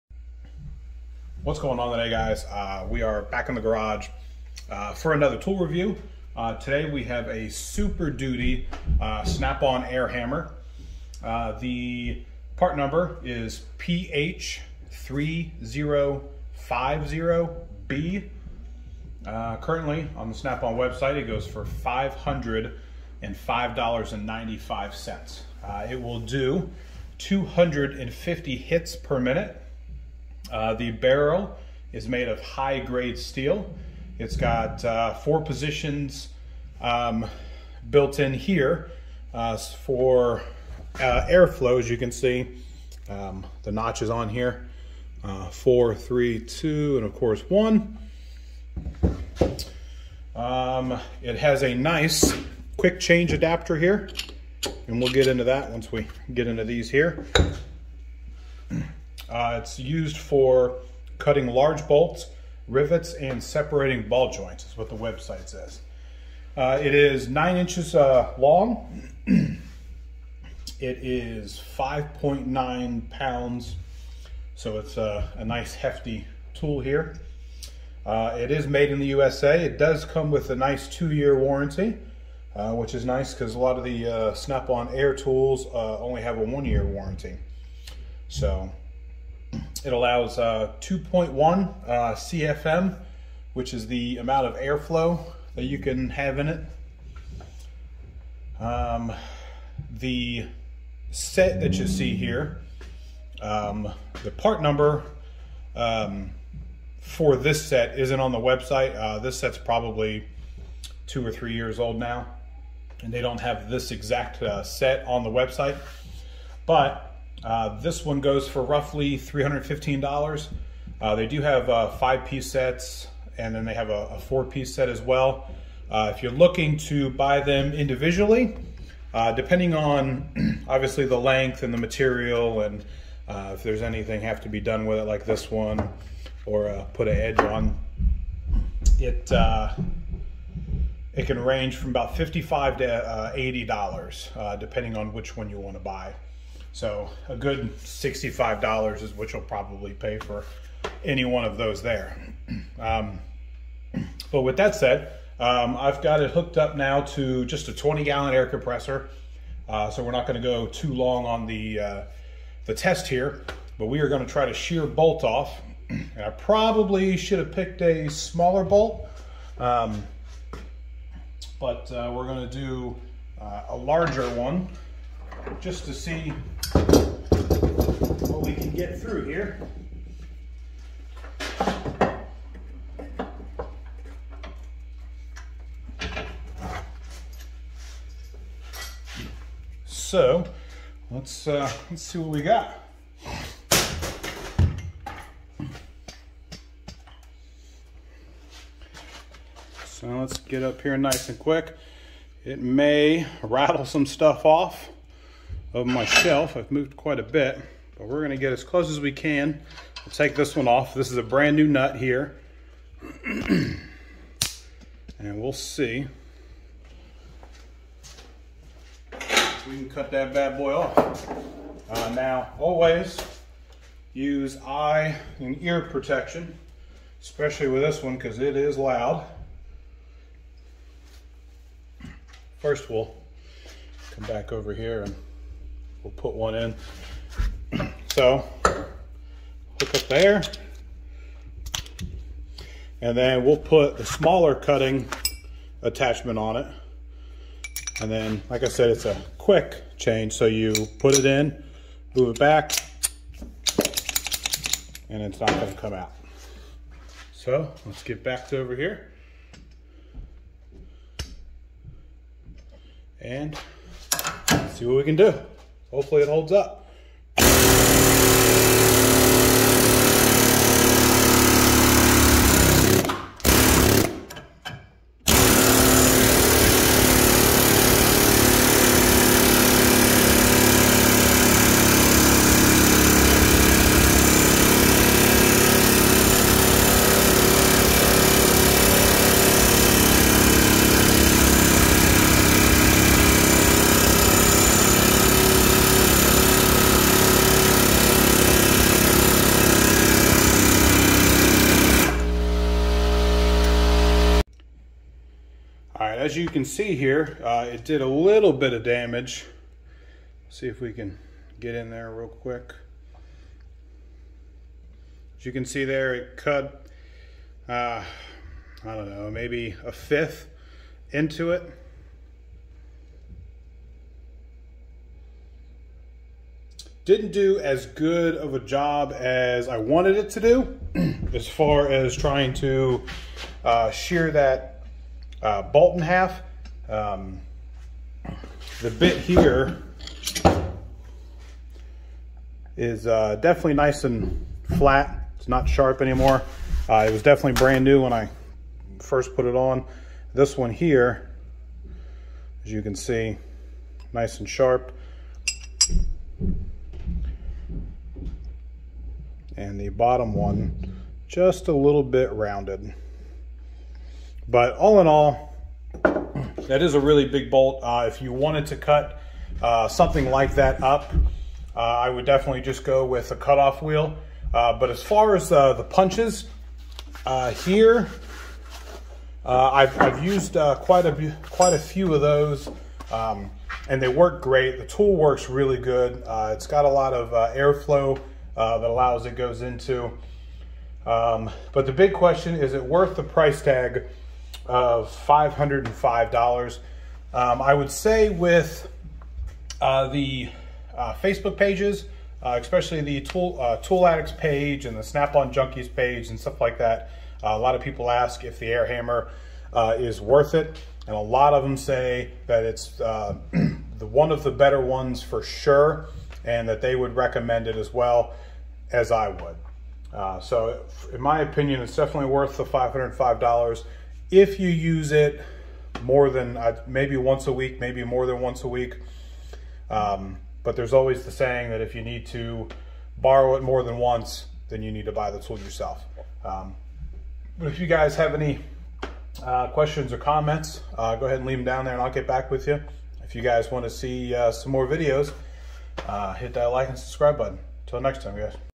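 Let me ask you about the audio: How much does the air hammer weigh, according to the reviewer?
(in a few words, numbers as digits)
5.9 pounds.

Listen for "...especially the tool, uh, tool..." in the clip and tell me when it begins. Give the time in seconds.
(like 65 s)
402 s.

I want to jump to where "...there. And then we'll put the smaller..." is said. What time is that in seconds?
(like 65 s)
240 s.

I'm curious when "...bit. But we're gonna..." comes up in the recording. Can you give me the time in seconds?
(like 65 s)
207 s.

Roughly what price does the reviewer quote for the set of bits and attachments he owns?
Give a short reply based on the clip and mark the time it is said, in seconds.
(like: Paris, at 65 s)
$315, at 119 s.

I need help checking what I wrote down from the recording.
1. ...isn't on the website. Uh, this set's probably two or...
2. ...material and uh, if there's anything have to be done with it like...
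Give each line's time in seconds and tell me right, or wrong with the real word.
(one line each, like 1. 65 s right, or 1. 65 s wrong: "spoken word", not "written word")
1. 107 s right
2. 131 s right.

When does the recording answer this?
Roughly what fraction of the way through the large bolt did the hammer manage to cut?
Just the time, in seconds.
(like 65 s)
319 s.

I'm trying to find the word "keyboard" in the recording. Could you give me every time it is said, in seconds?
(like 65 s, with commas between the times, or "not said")
not said.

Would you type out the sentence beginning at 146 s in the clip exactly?
So a good $65 is what you'll probably pay for any one of those there.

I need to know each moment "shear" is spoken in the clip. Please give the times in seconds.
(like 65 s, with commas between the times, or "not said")
164 s, 333 s.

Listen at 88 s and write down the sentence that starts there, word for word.
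So it allows uh, 2.1 uh, CFM, which is the amount of airflow that you can have in it.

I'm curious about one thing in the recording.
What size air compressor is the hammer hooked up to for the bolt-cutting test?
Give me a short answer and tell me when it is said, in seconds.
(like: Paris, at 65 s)
20 gallon, at 157 s.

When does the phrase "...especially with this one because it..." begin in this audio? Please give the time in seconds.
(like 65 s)
227 s.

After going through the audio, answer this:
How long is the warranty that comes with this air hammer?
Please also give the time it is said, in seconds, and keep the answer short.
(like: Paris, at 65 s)
2 years, at 80 s.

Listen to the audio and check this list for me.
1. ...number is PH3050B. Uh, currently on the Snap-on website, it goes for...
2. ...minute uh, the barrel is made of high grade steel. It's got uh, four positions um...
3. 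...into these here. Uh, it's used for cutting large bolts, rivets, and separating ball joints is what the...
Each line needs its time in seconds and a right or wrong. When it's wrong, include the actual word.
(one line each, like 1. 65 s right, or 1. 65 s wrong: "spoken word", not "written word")
1. 12 s right
2. 29 s right
3. 56 s right.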